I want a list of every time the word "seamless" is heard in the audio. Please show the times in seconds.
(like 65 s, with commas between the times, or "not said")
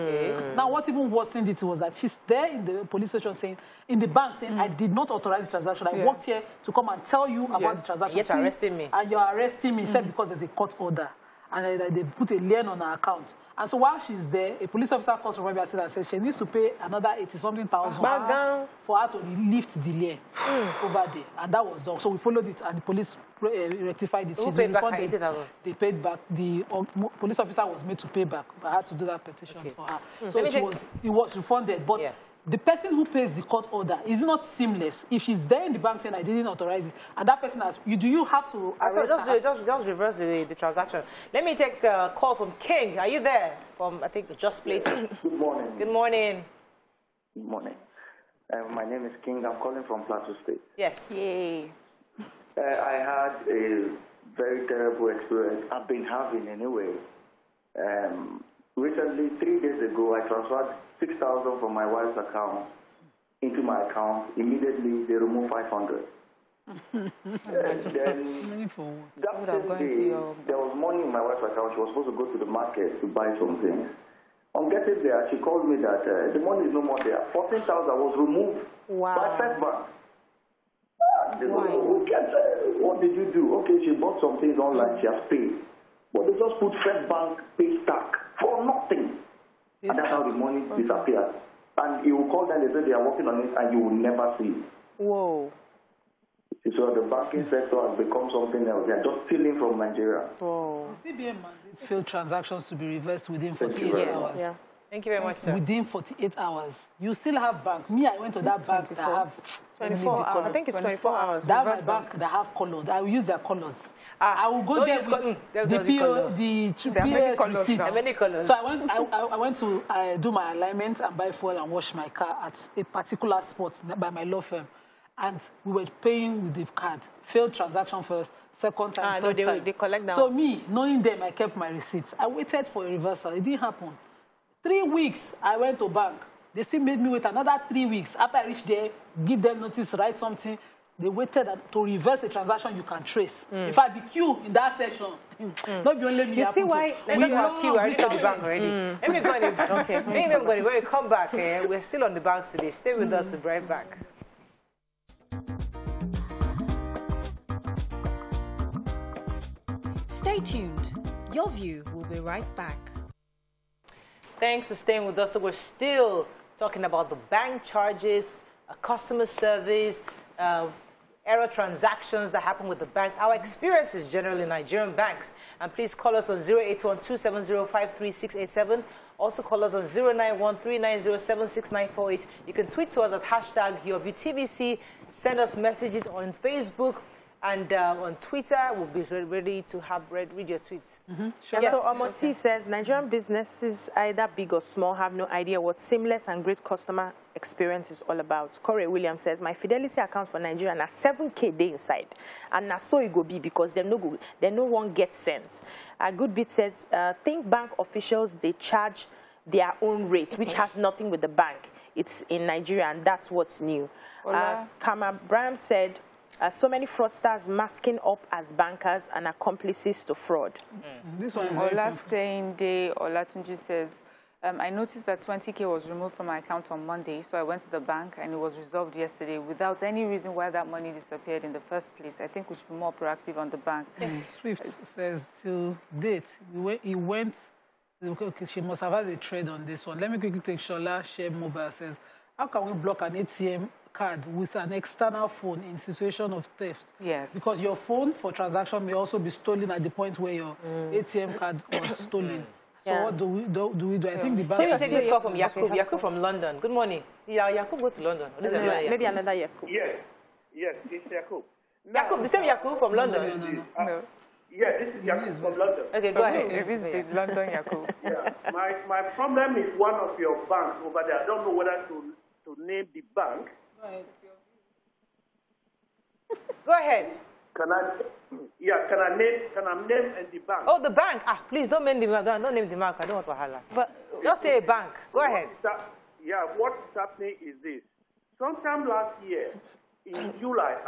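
34 s, 195 s.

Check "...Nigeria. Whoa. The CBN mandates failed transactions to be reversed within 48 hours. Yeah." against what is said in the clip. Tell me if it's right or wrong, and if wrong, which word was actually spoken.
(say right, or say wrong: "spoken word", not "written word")
right.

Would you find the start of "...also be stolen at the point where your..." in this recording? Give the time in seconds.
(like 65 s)
248 s.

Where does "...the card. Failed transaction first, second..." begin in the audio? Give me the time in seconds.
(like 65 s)
126 s.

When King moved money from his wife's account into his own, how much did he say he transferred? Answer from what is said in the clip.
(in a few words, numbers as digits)
6000.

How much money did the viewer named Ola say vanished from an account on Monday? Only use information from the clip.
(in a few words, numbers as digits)
20K.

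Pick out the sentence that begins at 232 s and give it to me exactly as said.
I think we should be more proactive on the bank.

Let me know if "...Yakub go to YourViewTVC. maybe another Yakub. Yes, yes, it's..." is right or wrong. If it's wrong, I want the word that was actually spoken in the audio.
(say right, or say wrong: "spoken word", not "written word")
wrong: "London", not "YourViewTVC".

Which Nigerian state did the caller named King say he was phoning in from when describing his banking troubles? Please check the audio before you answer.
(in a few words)
Plateau State.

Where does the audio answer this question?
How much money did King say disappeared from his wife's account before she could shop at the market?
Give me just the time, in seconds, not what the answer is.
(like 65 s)
77 s.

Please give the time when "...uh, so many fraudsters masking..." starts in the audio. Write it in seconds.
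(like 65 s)
216 s.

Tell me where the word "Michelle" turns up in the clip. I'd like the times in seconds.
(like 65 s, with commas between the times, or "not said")
not said.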